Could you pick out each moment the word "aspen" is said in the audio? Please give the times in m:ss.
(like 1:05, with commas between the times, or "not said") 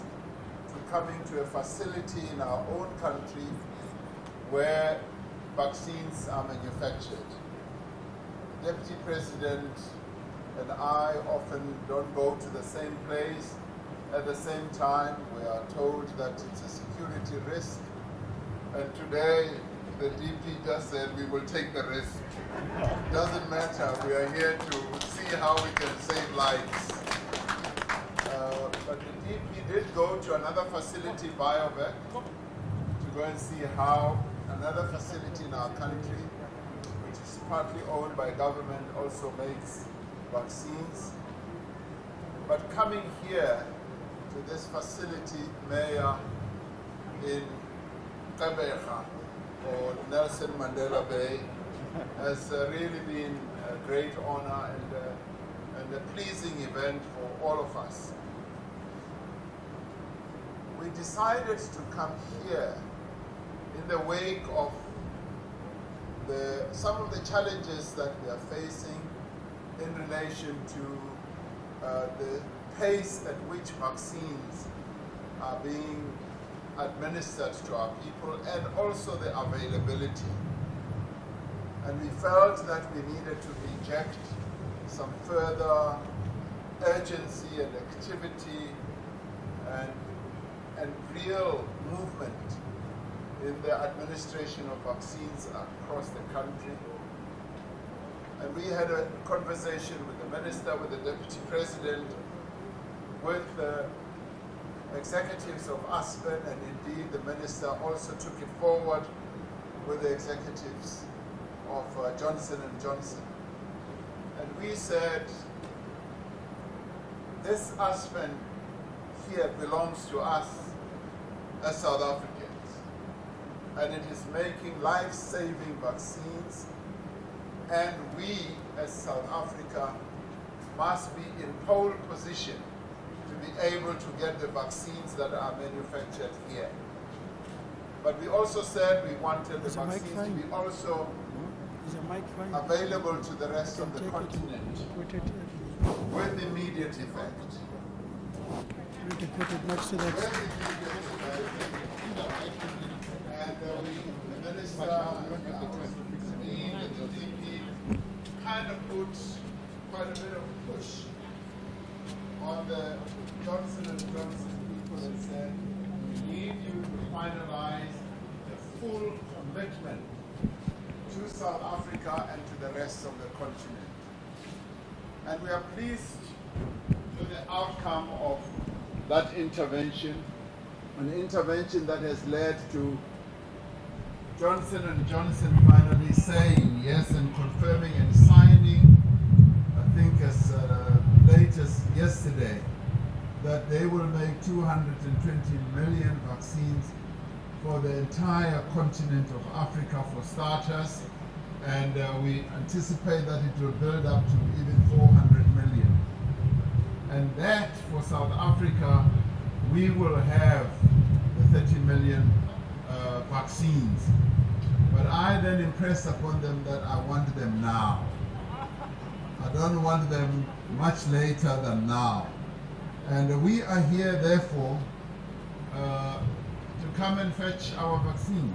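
1:45, 1:57.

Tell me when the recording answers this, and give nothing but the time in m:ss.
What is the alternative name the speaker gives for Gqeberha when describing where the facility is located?
0:50.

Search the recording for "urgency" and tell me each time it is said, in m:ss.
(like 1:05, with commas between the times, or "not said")
1:26.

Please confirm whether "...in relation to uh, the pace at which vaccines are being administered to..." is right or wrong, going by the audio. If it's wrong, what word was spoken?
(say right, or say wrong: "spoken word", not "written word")
right.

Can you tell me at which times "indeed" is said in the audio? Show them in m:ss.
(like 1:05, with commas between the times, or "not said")
0:29, 1:46.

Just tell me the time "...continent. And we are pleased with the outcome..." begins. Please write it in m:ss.
2:53.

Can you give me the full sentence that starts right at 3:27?
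And that for South Africa, we will have the 30 million uh, vaccines.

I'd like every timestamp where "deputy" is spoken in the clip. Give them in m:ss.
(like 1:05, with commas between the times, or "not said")
0:08, 1:41.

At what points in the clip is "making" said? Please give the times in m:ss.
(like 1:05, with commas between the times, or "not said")
2:04.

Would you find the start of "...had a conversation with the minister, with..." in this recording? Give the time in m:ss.
1:38.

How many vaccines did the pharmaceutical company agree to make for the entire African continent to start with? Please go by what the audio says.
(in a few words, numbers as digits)
220 million.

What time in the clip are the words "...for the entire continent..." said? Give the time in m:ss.
3:17.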